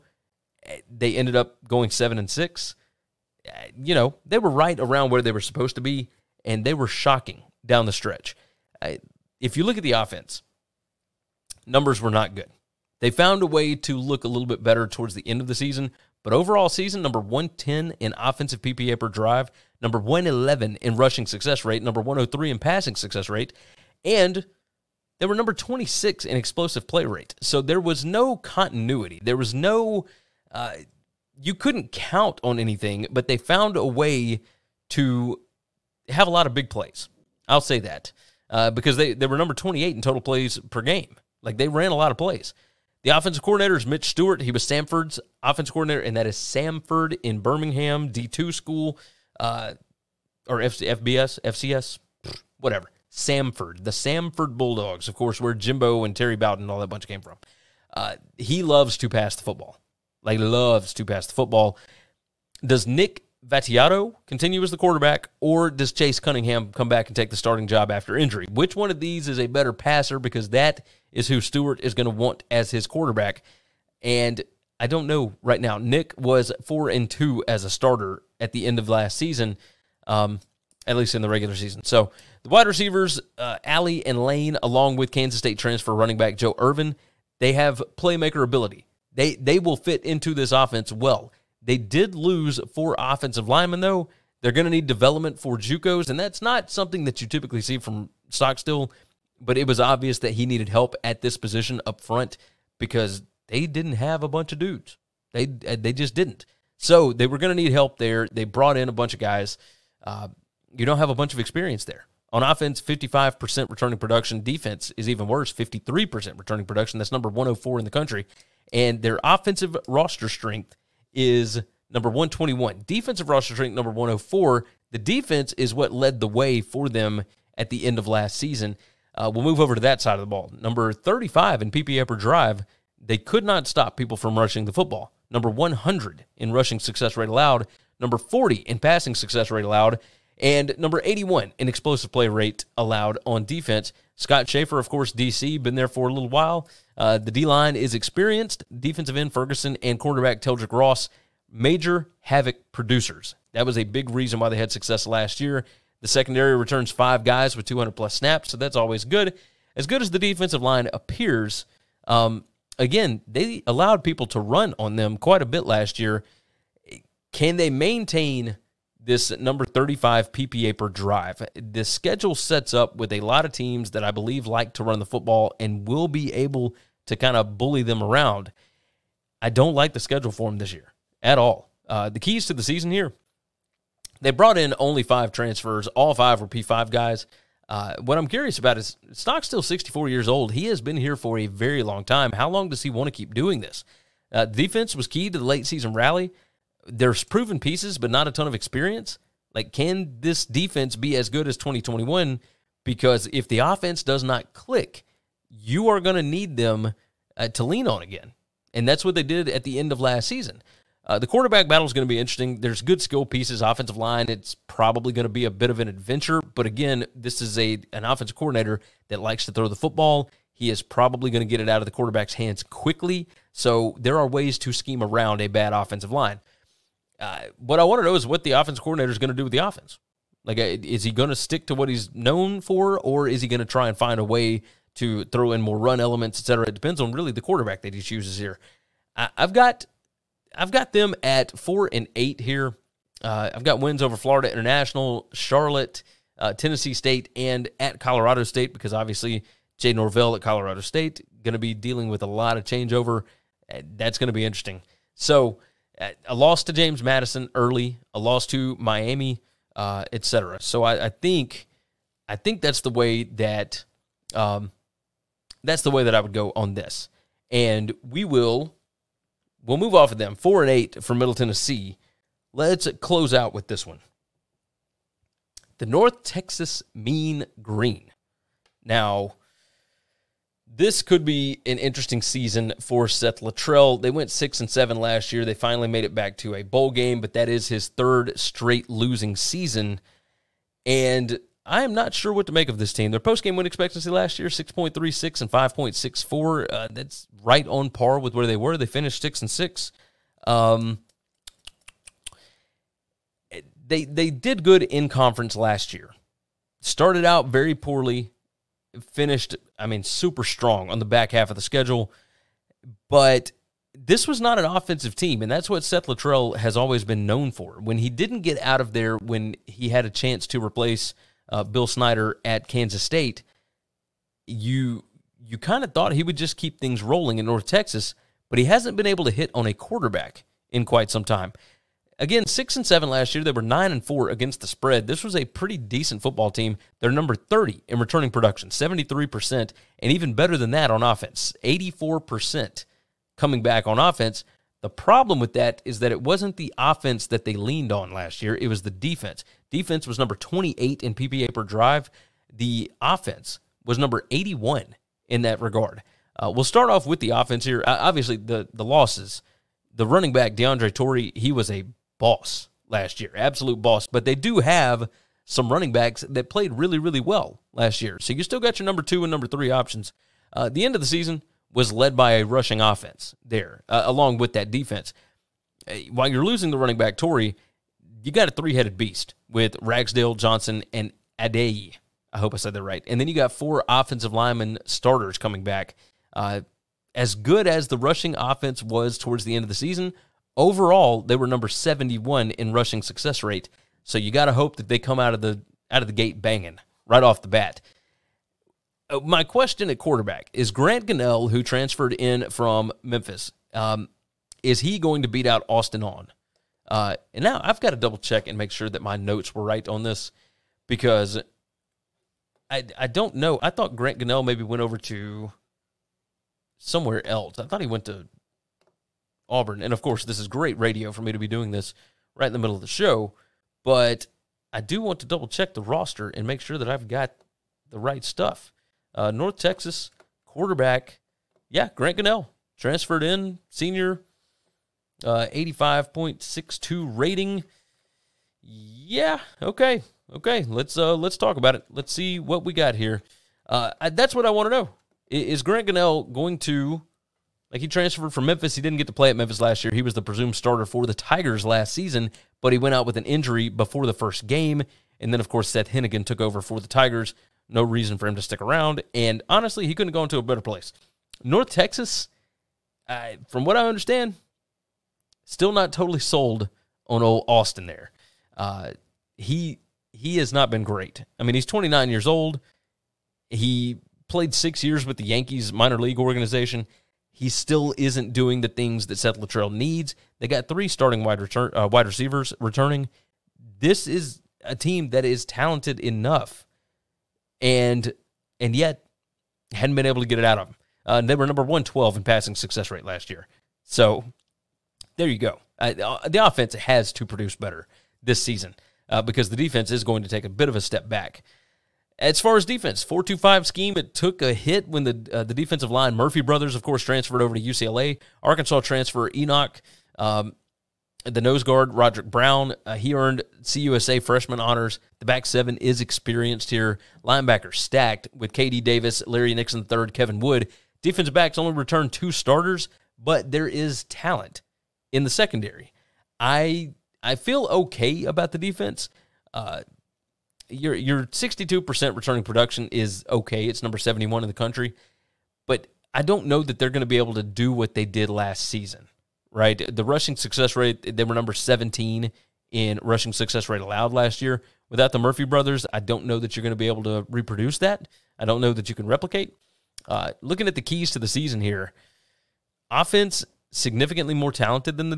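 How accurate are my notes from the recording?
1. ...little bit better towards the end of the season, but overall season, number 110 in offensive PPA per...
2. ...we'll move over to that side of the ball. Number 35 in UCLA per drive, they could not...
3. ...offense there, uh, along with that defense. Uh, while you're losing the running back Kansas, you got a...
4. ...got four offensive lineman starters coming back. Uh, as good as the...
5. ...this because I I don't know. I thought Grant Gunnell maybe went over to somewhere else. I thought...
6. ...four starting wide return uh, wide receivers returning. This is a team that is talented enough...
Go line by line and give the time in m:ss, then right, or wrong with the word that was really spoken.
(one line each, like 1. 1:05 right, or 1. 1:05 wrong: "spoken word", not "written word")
1. 0:14 right
2. 2:09 wrong: "PPA", not "UCLA"
3. 6:12 wrong: "Torrey", not "Kansas"
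4. 6:23 right
5. 6:50 right
6. 8:00 wrong: "three", not "four".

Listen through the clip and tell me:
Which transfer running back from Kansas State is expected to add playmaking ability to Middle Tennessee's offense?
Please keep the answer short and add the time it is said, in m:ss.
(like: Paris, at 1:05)
Joe Ervin, at 1:26.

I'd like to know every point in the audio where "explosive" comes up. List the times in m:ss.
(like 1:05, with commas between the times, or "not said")
0:26, 2:21.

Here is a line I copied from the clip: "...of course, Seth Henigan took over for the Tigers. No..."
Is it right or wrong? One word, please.
right.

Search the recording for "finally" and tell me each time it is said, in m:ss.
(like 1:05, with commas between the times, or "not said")
4:45.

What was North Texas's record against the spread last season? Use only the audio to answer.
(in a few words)
9-4.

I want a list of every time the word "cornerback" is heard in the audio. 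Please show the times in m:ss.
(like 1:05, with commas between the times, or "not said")
2:29.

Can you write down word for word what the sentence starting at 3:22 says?
Because if the offense does not click, you are going to need them uh, to lean on again.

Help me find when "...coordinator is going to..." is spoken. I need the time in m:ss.
3:48.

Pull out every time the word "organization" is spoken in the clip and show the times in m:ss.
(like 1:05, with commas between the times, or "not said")
7:56.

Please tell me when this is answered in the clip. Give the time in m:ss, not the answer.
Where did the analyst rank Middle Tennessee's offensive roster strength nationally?
2:01.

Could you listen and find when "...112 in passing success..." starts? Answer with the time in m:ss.
8:11.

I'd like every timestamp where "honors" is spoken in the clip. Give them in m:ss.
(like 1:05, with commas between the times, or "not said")
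8:34.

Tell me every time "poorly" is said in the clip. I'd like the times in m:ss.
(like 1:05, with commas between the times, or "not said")
5:07.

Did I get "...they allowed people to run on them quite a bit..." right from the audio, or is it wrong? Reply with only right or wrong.
right.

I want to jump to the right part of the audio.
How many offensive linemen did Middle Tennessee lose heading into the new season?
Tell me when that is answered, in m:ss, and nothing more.
1:32.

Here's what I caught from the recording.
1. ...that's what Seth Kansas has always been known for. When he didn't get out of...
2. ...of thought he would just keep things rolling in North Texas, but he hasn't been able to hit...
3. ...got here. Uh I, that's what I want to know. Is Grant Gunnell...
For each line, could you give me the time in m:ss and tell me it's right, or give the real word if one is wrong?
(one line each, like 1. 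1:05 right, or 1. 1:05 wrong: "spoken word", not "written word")
1. 5:15 wrong: "Littrell", not "Kansas"
2. 5:25 right
3. 7:22 right.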